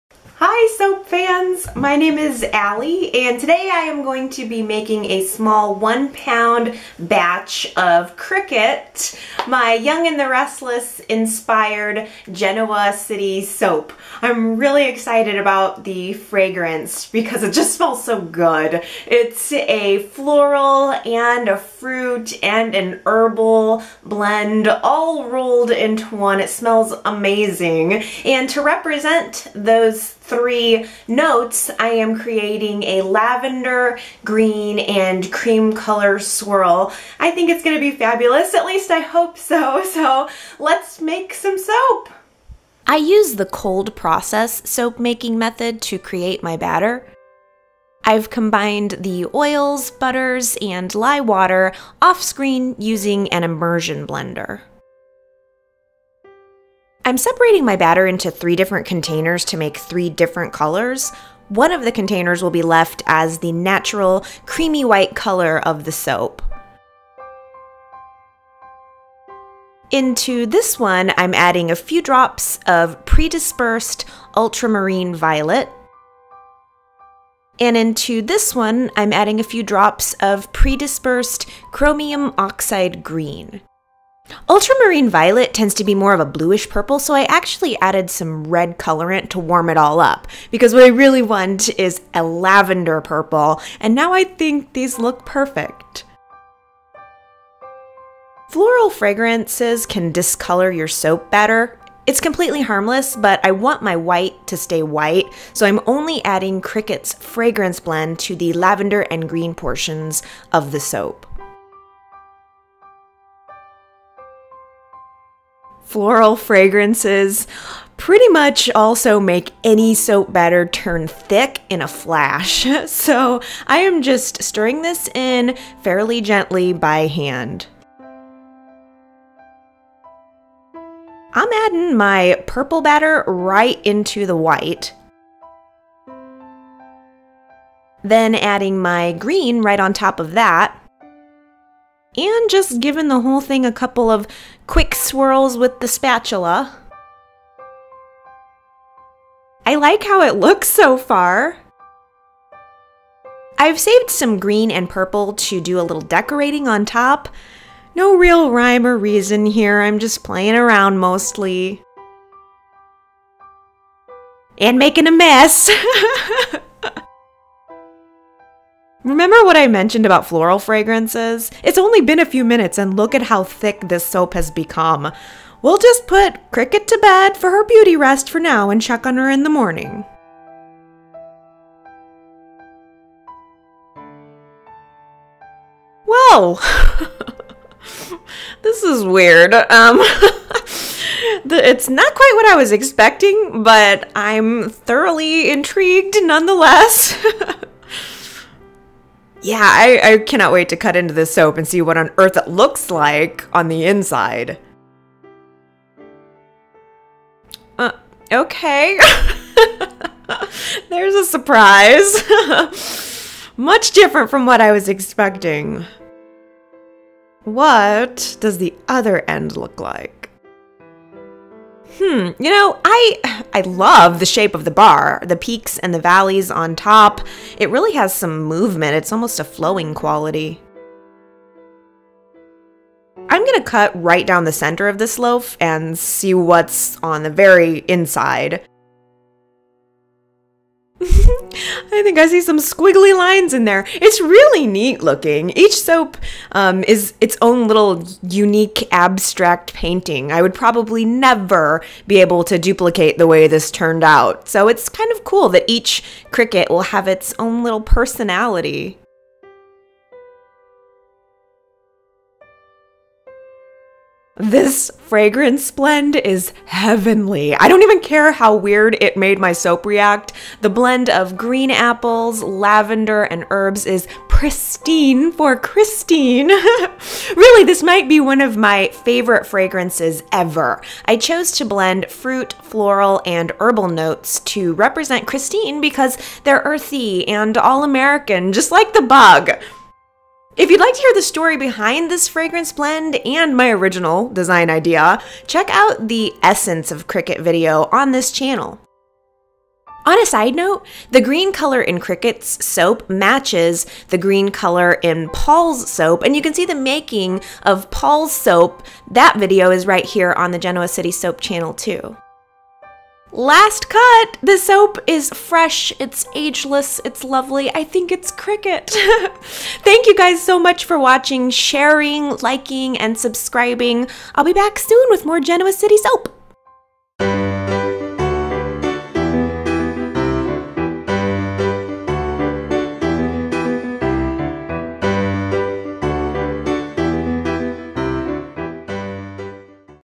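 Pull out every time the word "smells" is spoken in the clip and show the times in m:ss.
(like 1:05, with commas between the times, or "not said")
0:17, 0:26.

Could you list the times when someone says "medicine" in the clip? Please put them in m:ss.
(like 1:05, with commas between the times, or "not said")
not said.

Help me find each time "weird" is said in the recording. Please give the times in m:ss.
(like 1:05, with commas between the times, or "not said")
3:09, 4:28.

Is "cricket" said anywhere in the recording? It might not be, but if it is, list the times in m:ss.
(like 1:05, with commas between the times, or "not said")
0:08, 1:46, 2:56, 4:16, 4:57, 5:02, 5:18.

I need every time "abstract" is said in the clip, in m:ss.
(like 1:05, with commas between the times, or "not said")
4:08.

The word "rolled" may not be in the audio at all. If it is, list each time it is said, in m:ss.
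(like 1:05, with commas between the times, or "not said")
0:25.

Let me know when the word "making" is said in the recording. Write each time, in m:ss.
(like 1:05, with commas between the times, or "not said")
0:04, 0:44, 2:44, 5:06.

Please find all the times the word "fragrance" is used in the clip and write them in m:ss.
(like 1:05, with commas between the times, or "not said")
0:16, 1:38, 1:47, 1:56, 2:50, 4:25, 4:39, 4:52.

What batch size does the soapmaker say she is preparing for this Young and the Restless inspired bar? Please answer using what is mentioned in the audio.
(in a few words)
1 pound.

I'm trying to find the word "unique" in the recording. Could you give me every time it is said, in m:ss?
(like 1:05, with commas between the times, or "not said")
4:08.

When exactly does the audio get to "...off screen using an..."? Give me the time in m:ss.
0:52.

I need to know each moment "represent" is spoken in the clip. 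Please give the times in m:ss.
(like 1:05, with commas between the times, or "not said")
0:28, 4:44.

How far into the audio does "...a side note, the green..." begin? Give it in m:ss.
5:00.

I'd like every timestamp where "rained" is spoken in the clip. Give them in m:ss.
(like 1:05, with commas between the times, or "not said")
not said.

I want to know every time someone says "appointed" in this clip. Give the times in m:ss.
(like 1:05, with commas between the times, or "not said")
not said.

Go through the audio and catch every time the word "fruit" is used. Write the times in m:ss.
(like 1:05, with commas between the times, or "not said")
0:21, 4:42.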